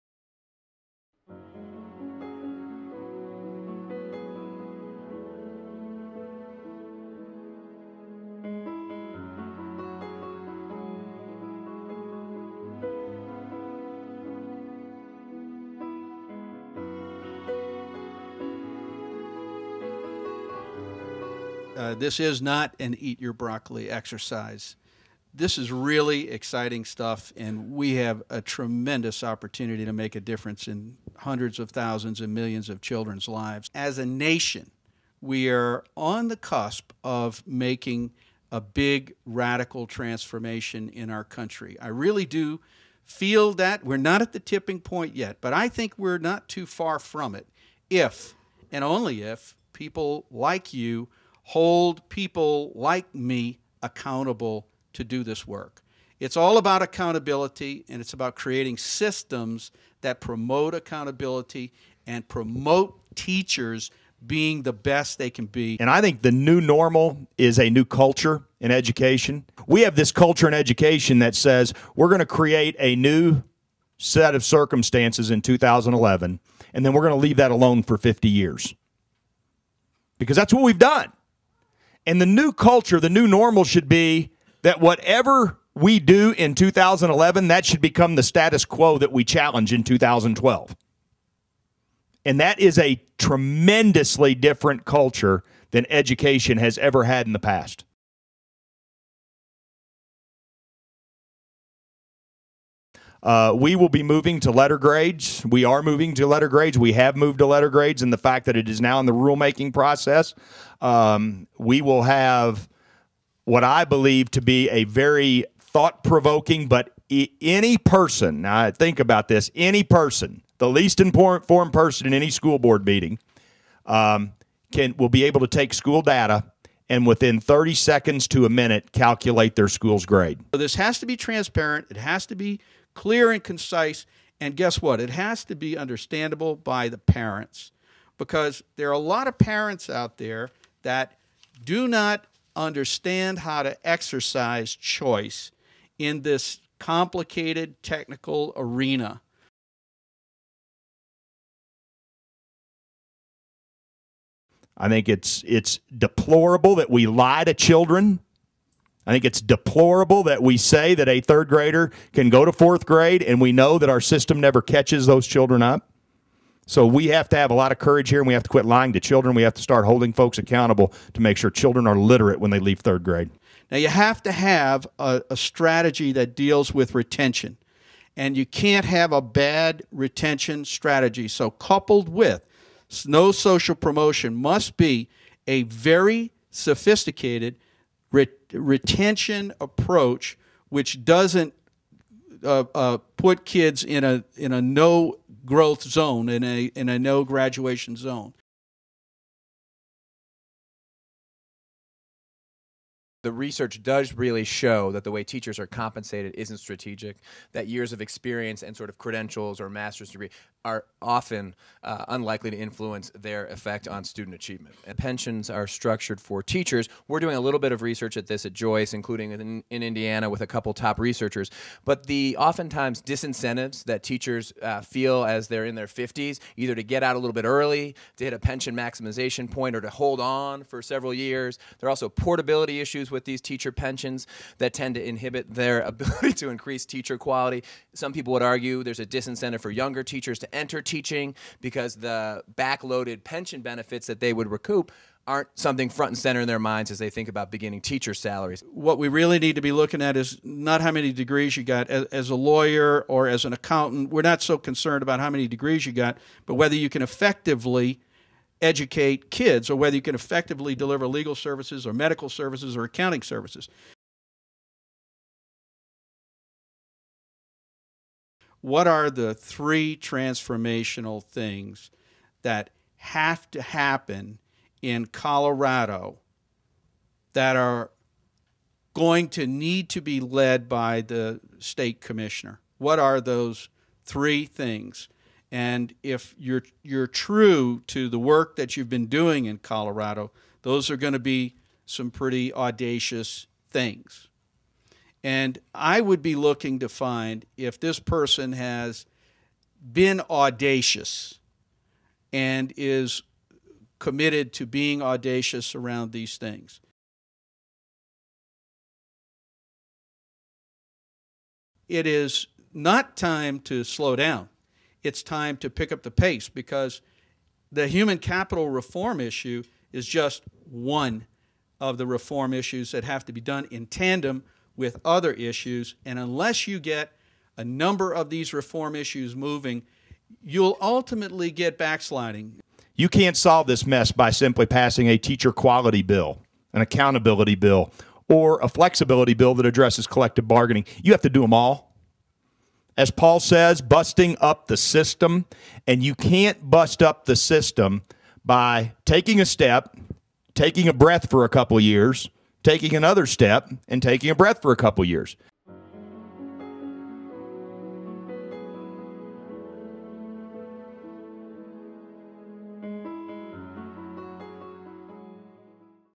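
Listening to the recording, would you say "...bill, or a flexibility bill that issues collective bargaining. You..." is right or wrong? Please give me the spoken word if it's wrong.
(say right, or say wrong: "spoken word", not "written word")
wrong: "addresses", not "issues".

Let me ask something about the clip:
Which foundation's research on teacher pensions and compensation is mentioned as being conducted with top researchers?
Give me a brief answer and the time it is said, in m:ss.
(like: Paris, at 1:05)
Joyce, at 3:38.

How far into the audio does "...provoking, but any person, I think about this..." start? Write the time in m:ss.
1:56.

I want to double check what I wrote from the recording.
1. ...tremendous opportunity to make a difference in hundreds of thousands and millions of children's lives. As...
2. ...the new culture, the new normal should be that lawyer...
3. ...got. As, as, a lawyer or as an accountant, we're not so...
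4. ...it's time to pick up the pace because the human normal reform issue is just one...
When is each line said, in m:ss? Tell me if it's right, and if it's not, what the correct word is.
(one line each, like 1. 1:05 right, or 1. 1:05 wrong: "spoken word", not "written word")
1. 0:28 right
2. 1:22 wrong: "whatever", not "lawyer"
3. 4:11 right
4. 5:15 wrong: "capital", not "normal".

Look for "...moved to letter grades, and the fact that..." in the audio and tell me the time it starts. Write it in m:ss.
1:47.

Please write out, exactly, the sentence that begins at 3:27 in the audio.
That years of experience and sort of credentials or master's degree are often uh, unlikely to influence their effect on student achievement.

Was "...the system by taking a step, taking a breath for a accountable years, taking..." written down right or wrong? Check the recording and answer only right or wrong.
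wrong.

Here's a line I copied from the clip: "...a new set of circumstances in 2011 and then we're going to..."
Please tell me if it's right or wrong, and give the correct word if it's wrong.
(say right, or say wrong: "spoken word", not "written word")
right.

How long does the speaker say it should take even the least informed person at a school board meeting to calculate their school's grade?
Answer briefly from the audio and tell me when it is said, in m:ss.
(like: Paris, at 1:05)
30 seconds to a minute, at 2:07.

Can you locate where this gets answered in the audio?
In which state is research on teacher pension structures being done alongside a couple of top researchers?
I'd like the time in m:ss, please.
3:39.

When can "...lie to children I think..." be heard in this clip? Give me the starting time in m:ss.
2:37.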